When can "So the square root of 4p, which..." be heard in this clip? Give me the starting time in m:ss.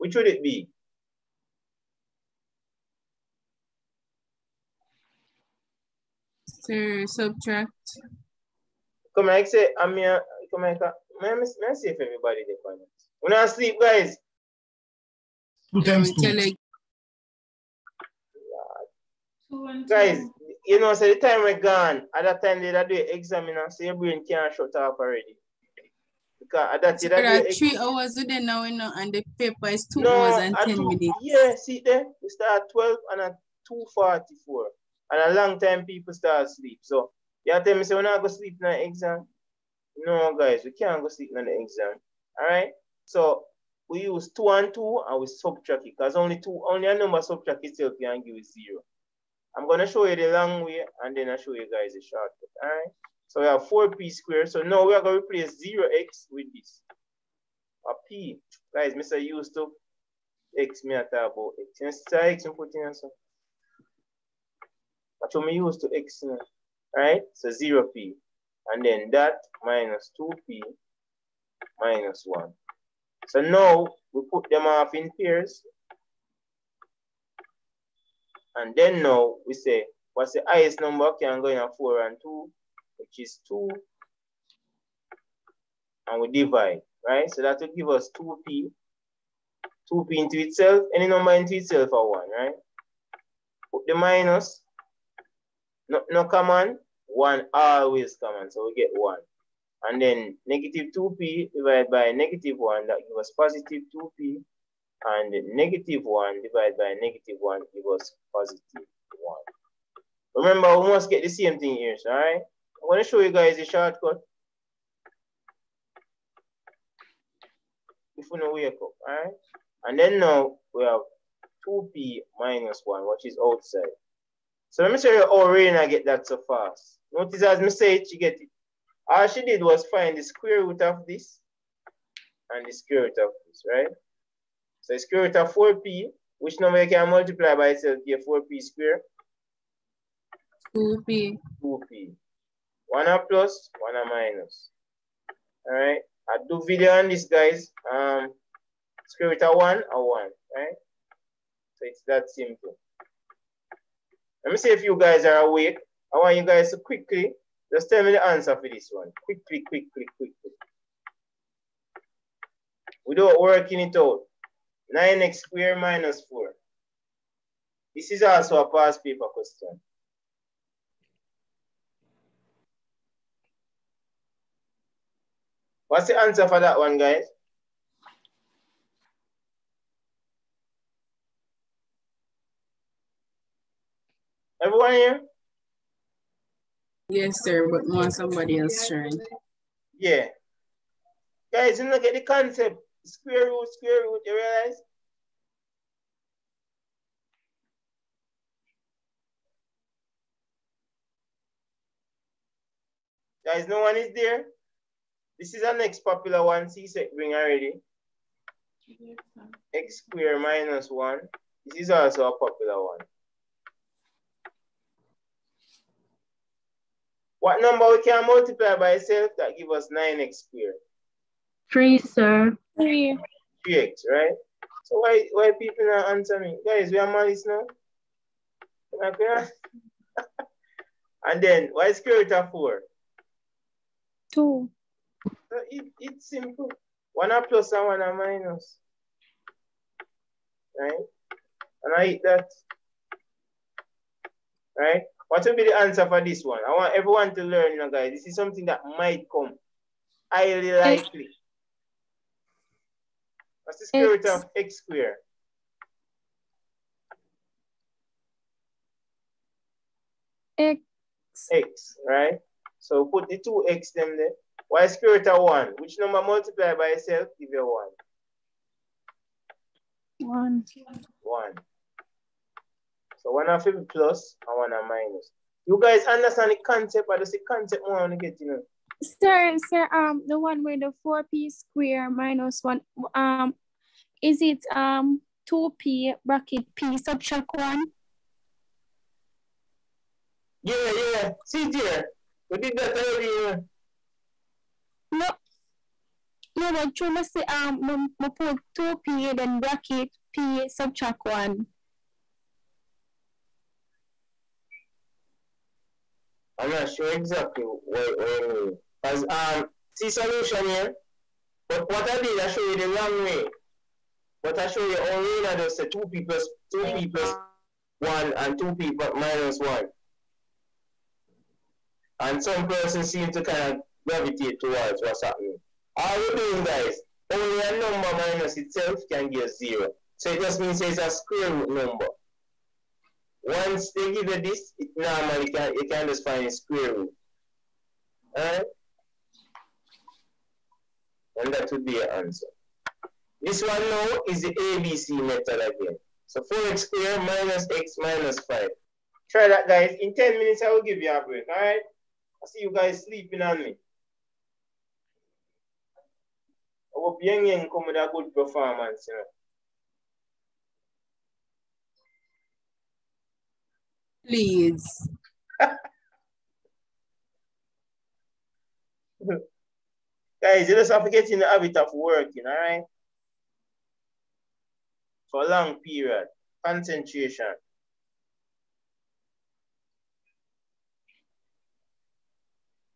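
2:14.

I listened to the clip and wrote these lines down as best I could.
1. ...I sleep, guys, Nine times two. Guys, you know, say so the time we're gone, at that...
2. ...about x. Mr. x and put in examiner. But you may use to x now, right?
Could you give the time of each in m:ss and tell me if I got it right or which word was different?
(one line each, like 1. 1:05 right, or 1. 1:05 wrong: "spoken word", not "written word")
1. 0:13 wrong: "Two", not "Nine"
2. 1:01 wrong: "answer", not "examiner".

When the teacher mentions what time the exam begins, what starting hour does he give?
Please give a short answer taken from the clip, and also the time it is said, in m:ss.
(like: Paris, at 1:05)
12, at 0:32.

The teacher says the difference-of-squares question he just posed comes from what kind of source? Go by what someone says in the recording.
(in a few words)
past paper.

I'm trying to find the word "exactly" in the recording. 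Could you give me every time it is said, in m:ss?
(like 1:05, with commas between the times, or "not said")
5:07.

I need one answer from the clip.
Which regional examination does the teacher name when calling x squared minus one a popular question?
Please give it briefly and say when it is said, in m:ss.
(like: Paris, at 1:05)
CSEC, at 3:26.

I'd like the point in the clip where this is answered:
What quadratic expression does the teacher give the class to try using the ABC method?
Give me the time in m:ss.
5:46.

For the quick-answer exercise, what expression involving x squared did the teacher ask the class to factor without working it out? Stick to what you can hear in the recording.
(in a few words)
9x squared minus 4.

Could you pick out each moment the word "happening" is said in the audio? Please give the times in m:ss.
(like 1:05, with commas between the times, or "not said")
5:25.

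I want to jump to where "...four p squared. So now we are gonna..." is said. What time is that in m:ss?
0:53.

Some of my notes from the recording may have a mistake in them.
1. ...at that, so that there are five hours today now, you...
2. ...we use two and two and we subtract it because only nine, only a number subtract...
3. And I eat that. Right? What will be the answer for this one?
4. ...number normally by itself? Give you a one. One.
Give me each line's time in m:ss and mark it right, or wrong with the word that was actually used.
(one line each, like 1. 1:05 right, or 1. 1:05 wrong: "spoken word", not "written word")
1. 0:26 wrong: "three", not "five"
2. 0:43 wrong: "two", not "nine"
3. 4:01 right
4. 4:25 wrong: "multiply", not "normally".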